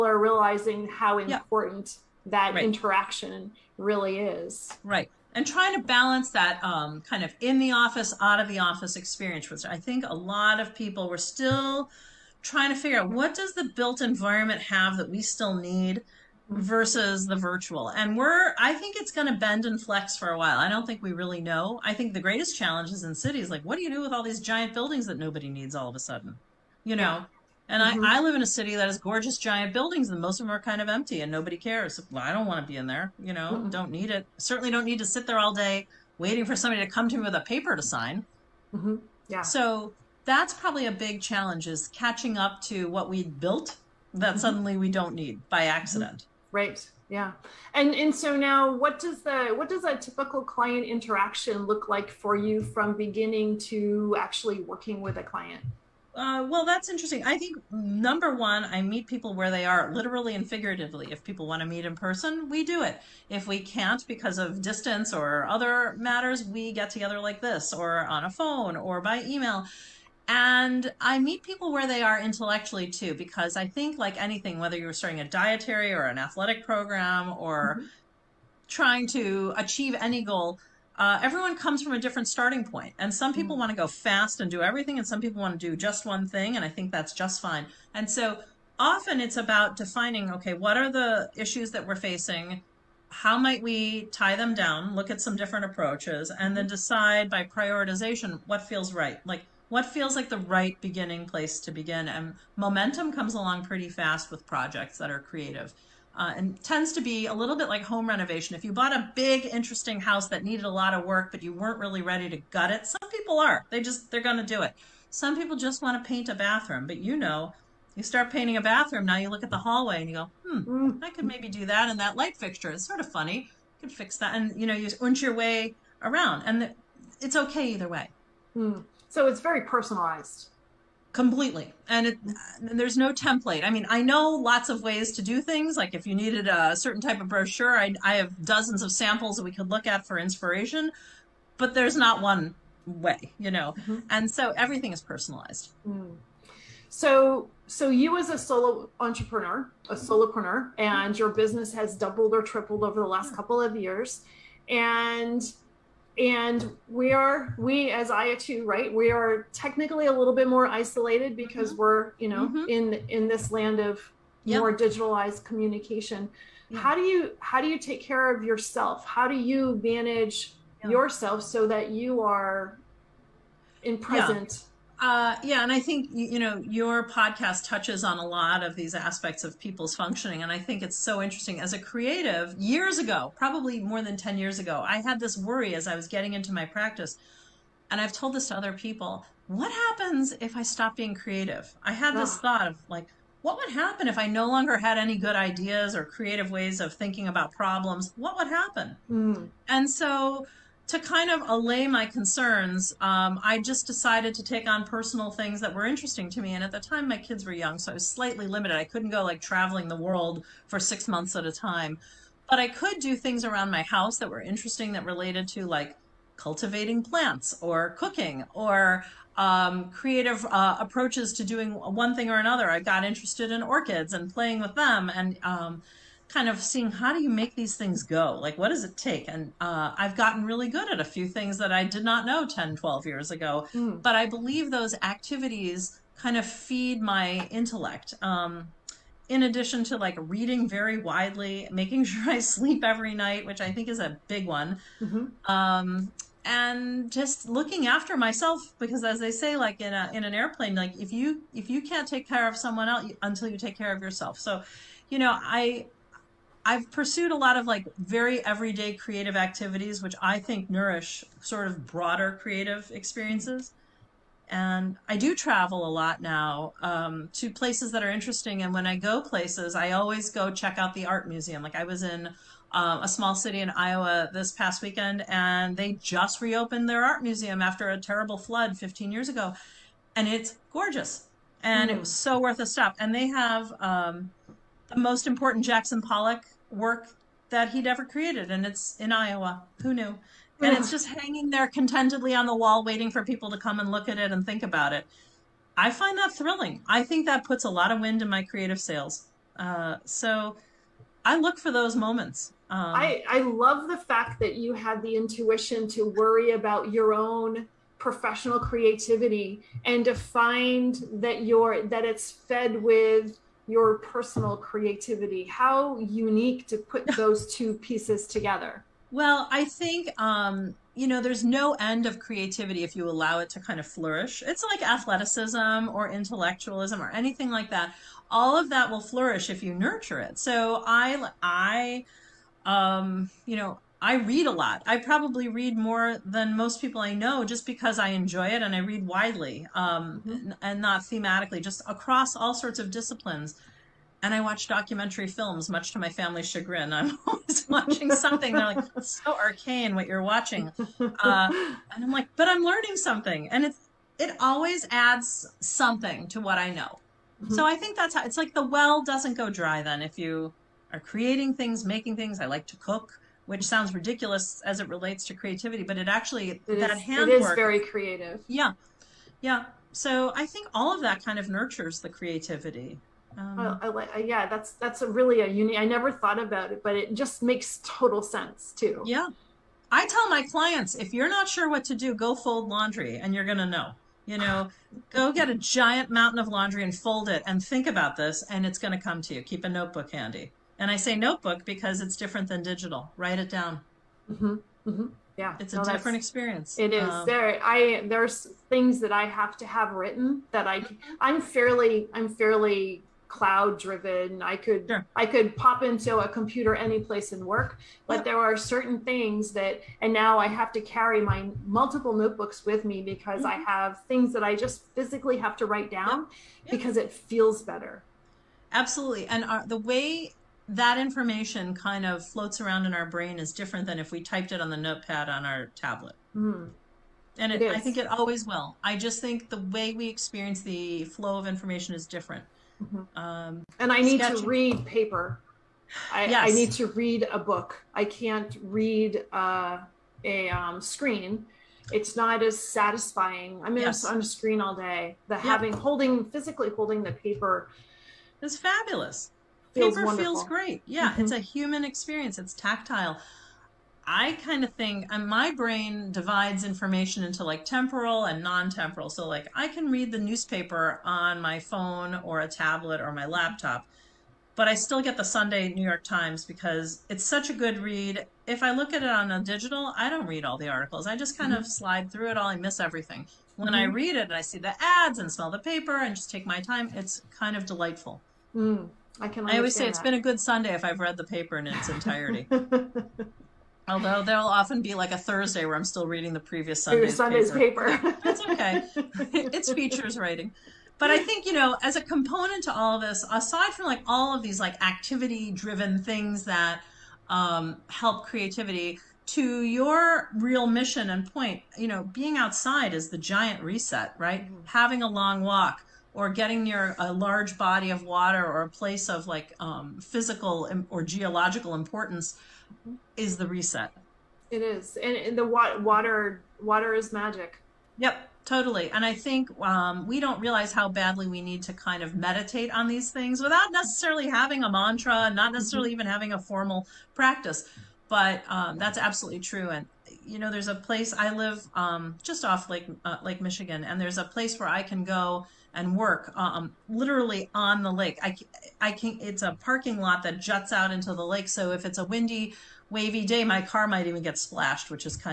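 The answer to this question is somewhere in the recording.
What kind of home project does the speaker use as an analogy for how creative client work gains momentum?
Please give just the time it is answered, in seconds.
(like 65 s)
107 s.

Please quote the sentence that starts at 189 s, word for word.
What happens if I stop being creative?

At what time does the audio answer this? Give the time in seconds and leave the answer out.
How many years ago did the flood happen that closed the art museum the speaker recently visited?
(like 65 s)
278 s.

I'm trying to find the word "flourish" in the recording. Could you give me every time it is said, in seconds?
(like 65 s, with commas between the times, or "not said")
323 s, 329 s.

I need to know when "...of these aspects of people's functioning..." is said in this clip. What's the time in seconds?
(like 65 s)
178 s.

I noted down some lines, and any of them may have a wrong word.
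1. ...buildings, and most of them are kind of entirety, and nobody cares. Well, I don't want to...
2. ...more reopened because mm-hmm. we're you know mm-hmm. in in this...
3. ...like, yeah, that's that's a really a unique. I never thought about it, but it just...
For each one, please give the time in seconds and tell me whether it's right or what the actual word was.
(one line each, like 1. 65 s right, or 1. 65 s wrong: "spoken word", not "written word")
1. 29 s wrong: "empty", not "entirety"
2. 160 s wrong: "isolated", not "reopened"
3. 373 s right.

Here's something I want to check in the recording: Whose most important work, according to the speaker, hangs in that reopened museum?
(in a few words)
Jackson Pollock.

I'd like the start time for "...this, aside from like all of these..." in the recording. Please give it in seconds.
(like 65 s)
493 s.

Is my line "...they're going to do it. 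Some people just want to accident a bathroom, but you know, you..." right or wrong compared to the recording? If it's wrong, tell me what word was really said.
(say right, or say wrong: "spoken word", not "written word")
wrong: "paint", not "accident".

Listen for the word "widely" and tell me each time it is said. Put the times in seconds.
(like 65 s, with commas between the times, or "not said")
240 s, 339 s.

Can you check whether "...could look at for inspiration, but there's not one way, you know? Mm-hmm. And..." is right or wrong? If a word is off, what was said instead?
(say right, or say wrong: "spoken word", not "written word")
right.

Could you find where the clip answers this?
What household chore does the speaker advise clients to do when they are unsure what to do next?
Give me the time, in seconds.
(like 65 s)
382 s.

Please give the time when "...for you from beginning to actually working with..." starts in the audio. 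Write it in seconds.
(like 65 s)
52 s.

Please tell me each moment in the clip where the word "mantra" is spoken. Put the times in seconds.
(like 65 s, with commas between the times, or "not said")
524 s.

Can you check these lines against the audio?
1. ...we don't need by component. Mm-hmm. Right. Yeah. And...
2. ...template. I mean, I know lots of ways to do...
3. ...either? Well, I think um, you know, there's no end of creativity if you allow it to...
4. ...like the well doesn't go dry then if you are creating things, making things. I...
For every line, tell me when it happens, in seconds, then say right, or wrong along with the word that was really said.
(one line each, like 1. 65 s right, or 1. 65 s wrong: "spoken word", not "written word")
1. 44 s wrong: "accident", not "component"
2. 133 s right
3. 318 s wrong: "together", not "either"
4. 358 s right.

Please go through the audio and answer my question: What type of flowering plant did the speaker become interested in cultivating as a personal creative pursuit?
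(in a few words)
Orchids.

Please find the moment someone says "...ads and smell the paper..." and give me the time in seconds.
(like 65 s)
474 s.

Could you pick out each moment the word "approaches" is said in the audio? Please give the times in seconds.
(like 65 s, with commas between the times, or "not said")
95 s, 220 s.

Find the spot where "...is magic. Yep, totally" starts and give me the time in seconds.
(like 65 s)
516 s.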